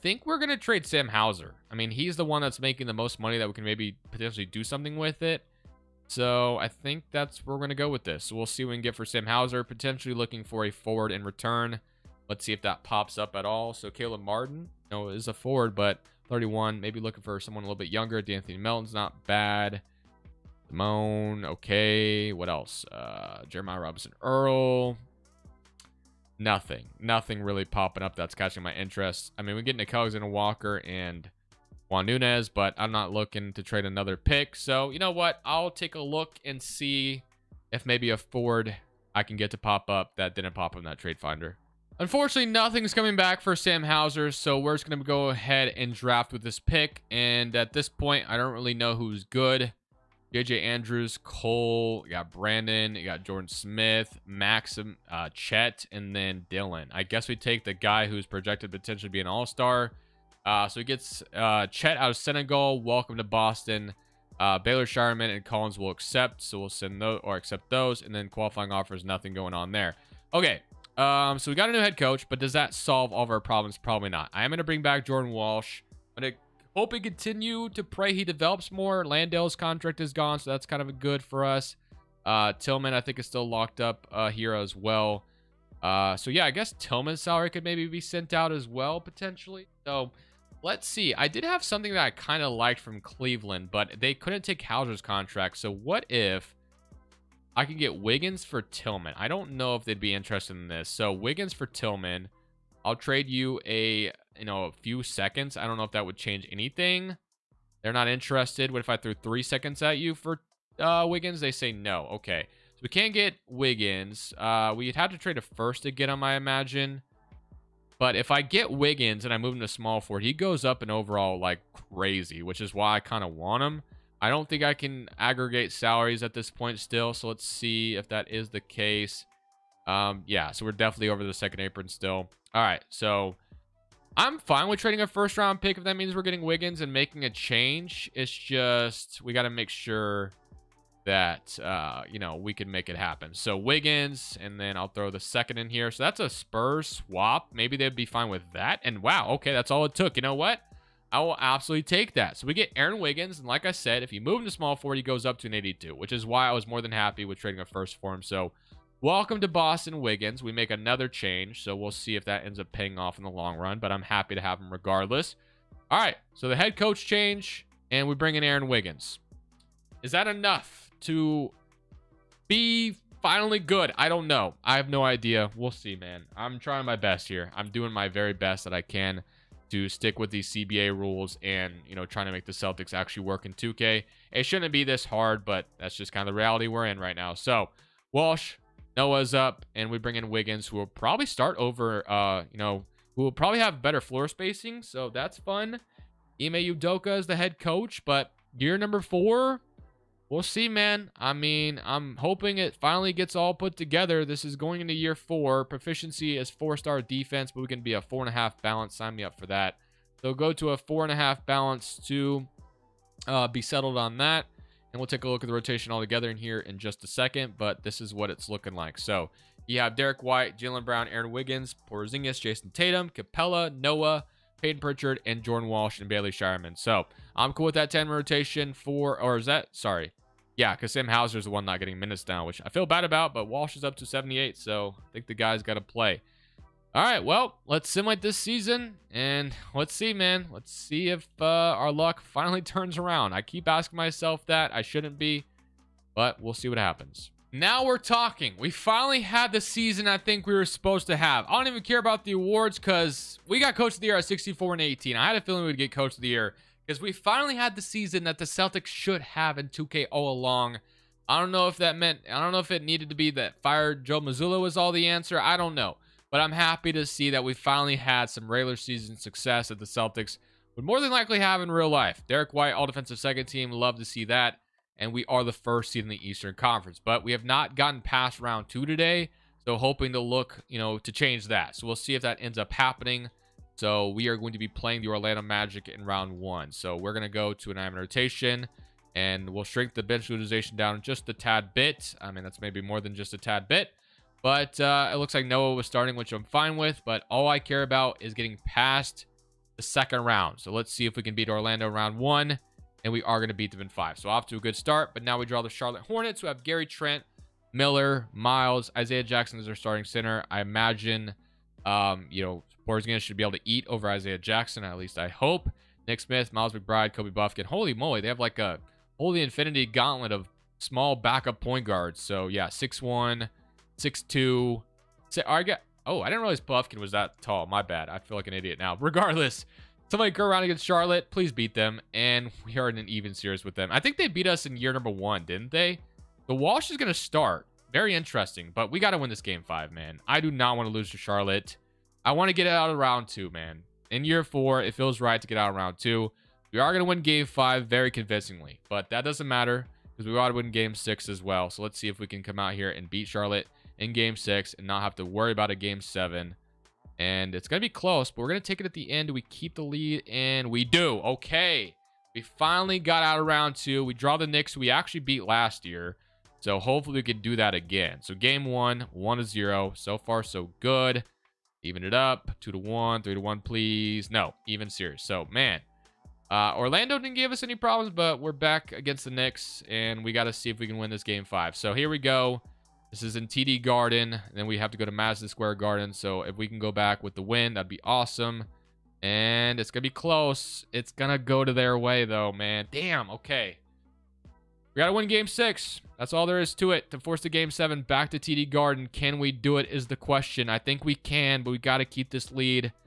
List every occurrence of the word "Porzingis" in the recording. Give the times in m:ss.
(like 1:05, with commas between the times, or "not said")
3:41, 5:12.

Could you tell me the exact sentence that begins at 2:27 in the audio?
Maybe they'd be fine with that.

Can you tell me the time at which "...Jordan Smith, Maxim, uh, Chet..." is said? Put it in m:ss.
0:53.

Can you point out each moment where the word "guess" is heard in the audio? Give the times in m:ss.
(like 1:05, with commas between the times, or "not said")
0:57, 1:26.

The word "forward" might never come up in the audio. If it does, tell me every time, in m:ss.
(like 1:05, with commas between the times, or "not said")
0:10, 0:15, 2:00, 2:34.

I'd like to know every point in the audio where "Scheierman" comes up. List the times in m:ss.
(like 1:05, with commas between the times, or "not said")
1:04, 3:46.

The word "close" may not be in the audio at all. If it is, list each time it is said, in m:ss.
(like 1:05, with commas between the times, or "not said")
5:57, 6:30.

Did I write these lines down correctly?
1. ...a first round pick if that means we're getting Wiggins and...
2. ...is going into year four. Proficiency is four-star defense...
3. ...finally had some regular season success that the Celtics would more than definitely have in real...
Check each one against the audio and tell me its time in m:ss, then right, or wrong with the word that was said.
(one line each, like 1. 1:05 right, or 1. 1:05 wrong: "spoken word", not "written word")
1. 2:15 right
2. 3:24 right
3. 4:27 wrong: "likely", not "definitely".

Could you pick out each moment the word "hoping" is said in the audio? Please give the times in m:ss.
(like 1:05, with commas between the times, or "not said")
3:22, 4:39.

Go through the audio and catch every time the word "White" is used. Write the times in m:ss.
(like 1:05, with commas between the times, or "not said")
3:40, 4:32.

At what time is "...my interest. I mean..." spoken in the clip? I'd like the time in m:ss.
0:28.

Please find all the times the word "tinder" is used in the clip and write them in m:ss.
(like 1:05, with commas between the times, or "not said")
not said.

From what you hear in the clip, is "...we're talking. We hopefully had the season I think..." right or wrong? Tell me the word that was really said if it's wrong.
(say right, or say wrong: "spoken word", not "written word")
wrong: "finally", not "hopefully".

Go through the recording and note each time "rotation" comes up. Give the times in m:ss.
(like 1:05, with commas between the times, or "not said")
3:35, 3:48, 4:47.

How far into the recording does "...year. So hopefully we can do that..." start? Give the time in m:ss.
6:05.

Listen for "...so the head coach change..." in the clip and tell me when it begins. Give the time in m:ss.
2:46.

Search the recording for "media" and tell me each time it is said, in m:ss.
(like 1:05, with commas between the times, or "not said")
not said.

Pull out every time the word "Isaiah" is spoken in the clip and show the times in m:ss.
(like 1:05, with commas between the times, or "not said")
5:08, 5:14.